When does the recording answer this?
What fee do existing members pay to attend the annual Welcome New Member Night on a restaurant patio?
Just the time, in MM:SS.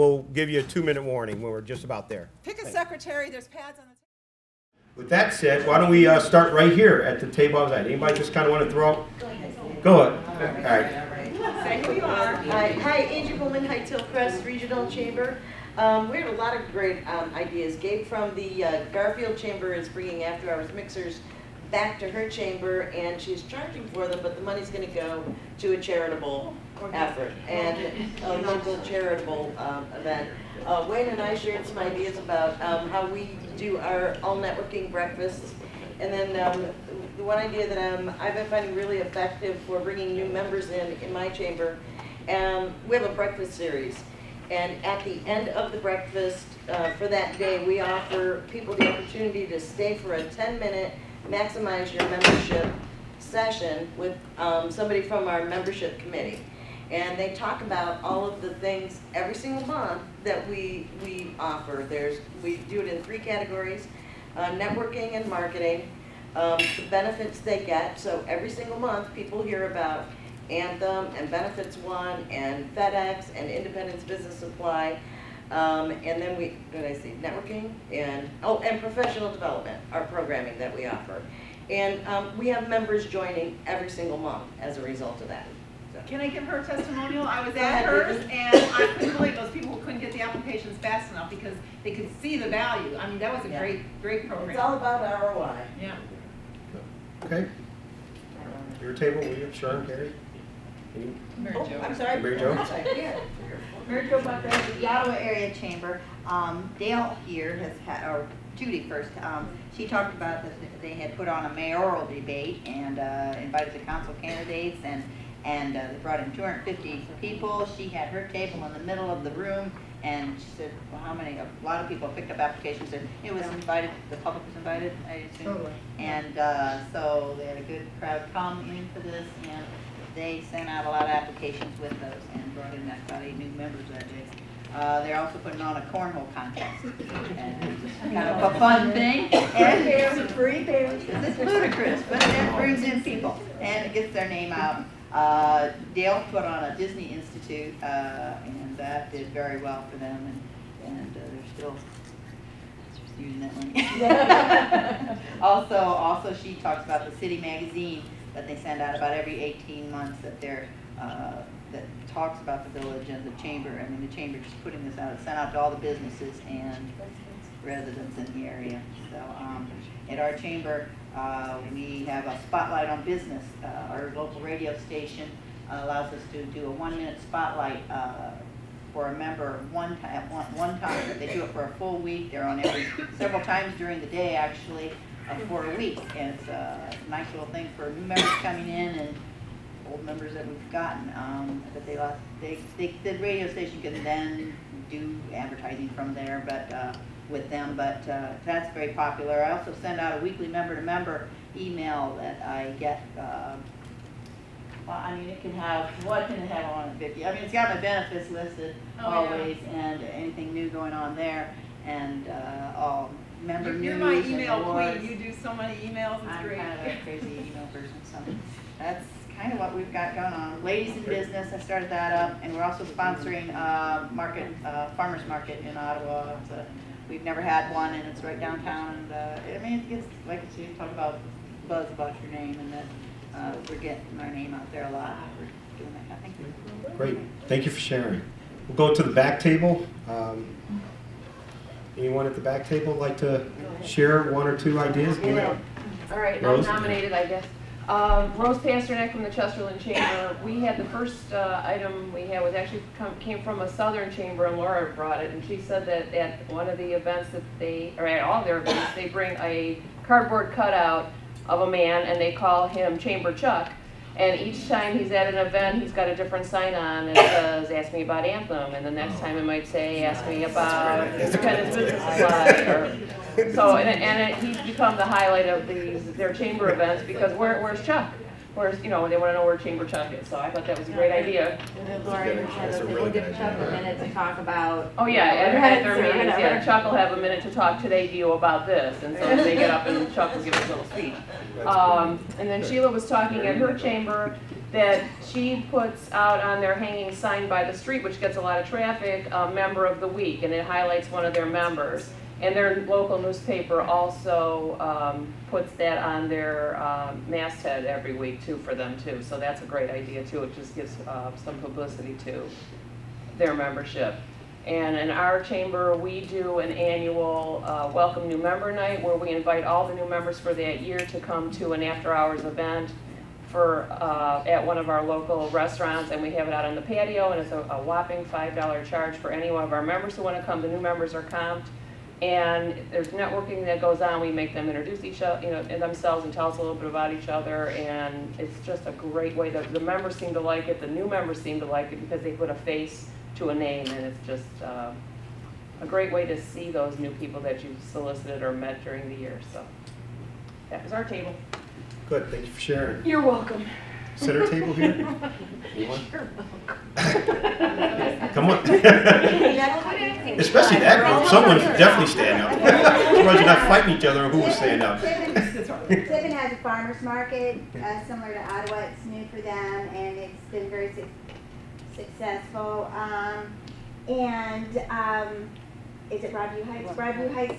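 05:28.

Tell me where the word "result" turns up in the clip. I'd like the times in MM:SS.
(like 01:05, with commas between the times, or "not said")
01:24.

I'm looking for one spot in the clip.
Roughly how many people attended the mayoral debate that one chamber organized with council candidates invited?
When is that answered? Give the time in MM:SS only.
01:56.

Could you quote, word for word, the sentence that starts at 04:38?
course, you know, they want to know where chamber Chuck is, so I thought that was a great idea.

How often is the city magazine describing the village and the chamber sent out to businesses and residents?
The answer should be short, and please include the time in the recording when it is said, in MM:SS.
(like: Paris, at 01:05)
Every 18 months, at 02:39.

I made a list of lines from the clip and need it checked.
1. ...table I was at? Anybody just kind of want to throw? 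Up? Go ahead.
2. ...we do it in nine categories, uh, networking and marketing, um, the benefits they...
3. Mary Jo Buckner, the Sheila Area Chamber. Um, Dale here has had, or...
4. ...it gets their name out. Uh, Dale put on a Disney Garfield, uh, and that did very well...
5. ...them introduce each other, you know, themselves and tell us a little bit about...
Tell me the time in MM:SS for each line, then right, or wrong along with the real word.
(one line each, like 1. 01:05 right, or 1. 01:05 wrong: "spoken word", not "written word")
1. 00:07 right
2. 01:02 wrong: "three", not "nine"
3. 01:43 wrong: "Ottawa", not "Sheila"
4. 02:23 wrong: "Institute", not "Garfield"
5. 05:34 right.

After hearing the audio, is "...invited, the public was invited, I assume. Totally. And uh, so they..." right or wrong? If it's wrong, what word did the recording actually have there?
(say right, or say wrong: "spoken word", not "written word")
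right.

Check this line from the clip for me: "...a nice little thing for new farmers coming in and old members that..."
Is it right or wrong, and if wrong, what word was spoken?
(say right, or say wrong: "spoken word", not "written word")
wrong: "members", not "farmers".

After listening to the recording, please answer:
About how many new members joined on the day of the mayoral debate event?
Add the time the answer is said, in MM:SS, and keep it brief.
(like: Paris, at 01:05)
8, at 02:13.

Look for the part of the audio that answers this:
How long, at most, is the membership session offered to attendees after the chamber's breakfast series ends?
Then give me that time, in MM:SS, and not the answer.
00:50.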